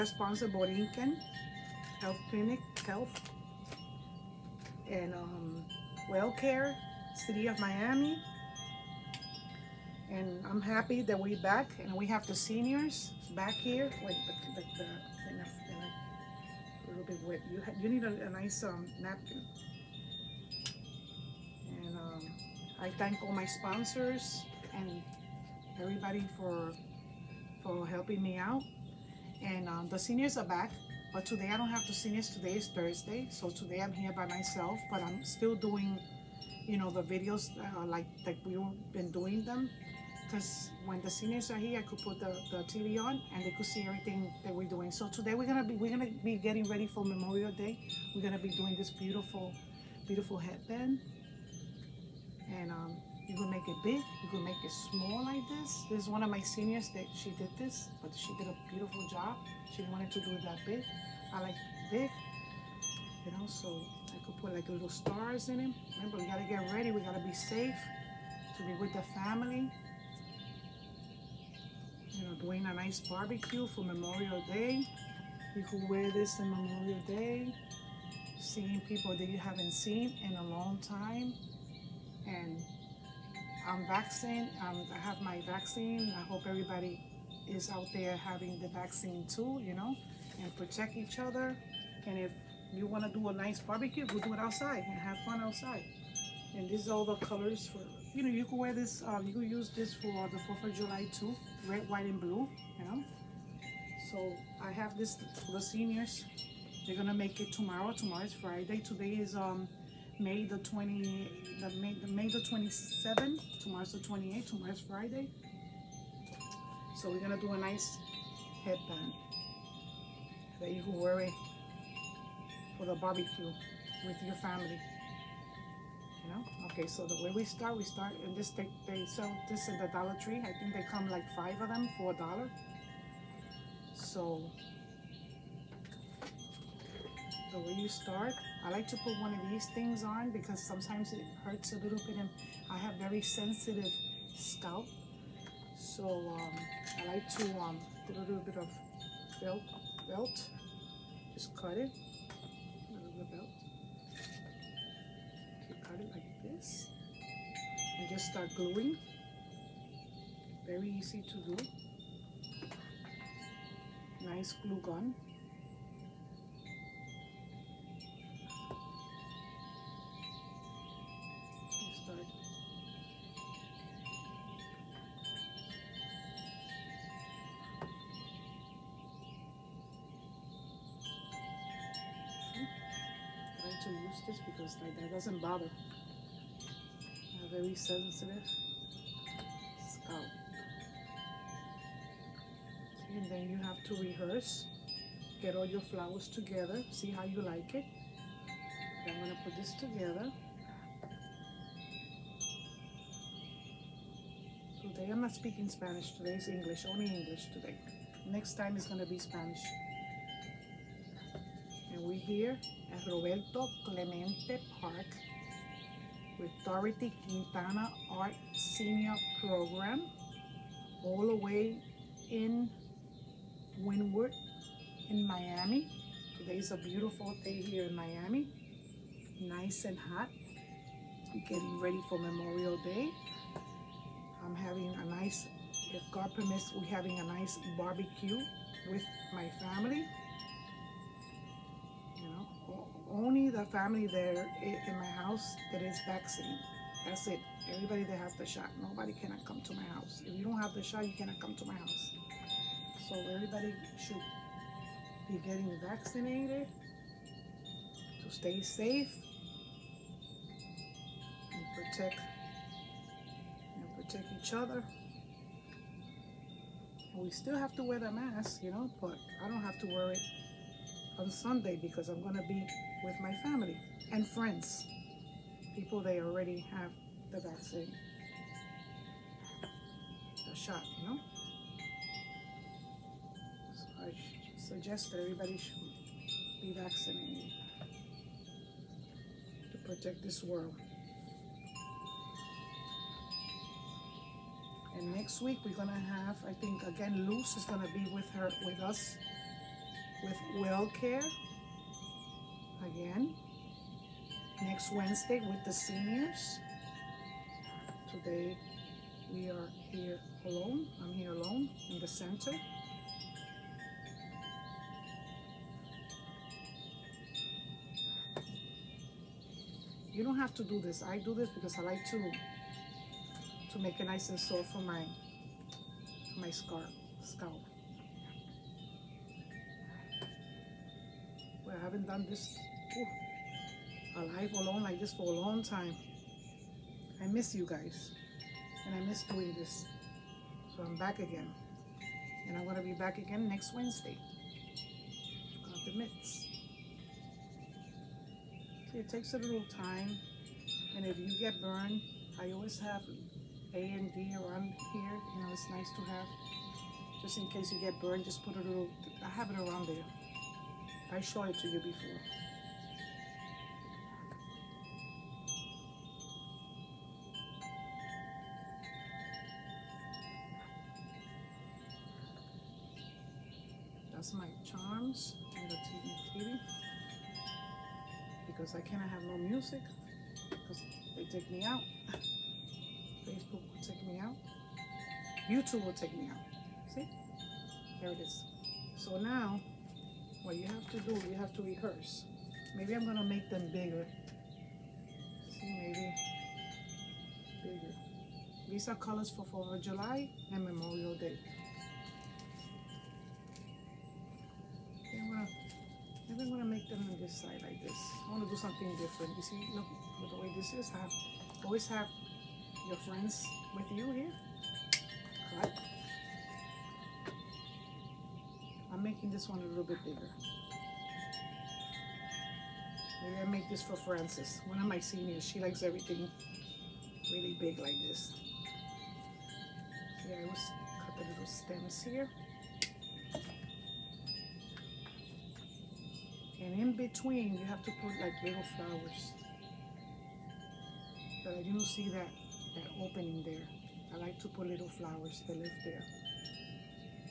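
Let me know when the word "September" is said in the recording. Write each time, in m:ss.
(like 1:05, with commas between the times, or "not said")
not said.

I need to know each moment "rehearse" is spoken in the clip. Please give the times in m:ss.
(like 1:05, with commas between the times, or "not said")
3:14, 6:31.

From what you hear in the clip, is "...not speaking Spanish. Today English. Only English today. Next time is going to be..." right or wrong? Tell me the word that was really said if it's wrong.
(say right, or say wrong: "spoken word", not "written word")
right.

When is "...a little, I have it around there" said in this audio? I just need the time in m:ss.
5:58.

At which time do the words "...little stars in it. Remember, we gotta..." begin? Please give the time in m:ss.
1:04.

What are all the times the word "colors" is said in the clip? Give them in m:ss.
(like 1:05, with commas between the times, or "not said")
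1:37, 6:38.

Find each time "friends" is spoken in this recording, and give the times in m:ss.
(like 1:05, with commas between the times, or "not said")
4:34, 6:52.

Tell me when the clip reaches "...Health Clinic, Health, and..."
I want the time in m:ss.
0:01.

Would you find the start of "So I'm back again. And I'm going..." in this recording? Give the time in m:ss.
5:40.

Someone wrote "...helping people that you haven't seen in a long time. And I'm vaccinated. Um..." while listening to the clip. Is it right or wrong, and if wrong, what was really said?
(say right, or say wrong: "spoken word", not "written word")
wrong: "seeing", not "helping".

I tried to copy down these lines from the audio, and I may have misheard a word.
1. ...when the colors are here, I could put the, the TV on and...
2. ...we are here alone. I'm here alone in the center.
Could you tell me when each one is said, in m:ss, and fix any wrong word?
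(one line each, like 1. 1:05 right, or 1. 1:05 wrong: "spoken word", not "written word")
1. 0:40 wrong: "seniors", not "colors"
2. 5:09 right.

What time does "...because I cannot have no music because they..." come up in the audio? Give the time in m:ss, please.
6:18.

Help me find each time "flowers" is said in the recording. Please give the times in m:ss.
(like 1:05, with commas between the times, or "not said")
3:15, 7:18, 7:24.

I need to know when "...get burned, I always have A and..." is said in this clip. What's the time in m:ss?
5:51.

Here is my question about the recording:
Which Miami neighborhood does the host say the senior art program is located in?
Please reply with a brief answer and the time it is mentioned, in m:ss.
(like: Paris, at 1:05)
Wynwood, at 3:43.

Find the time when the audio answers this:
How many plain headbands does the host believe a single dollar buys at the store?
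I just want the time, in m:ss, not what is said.
2:11.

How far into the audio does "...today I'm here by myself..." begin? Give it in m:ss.
0:33.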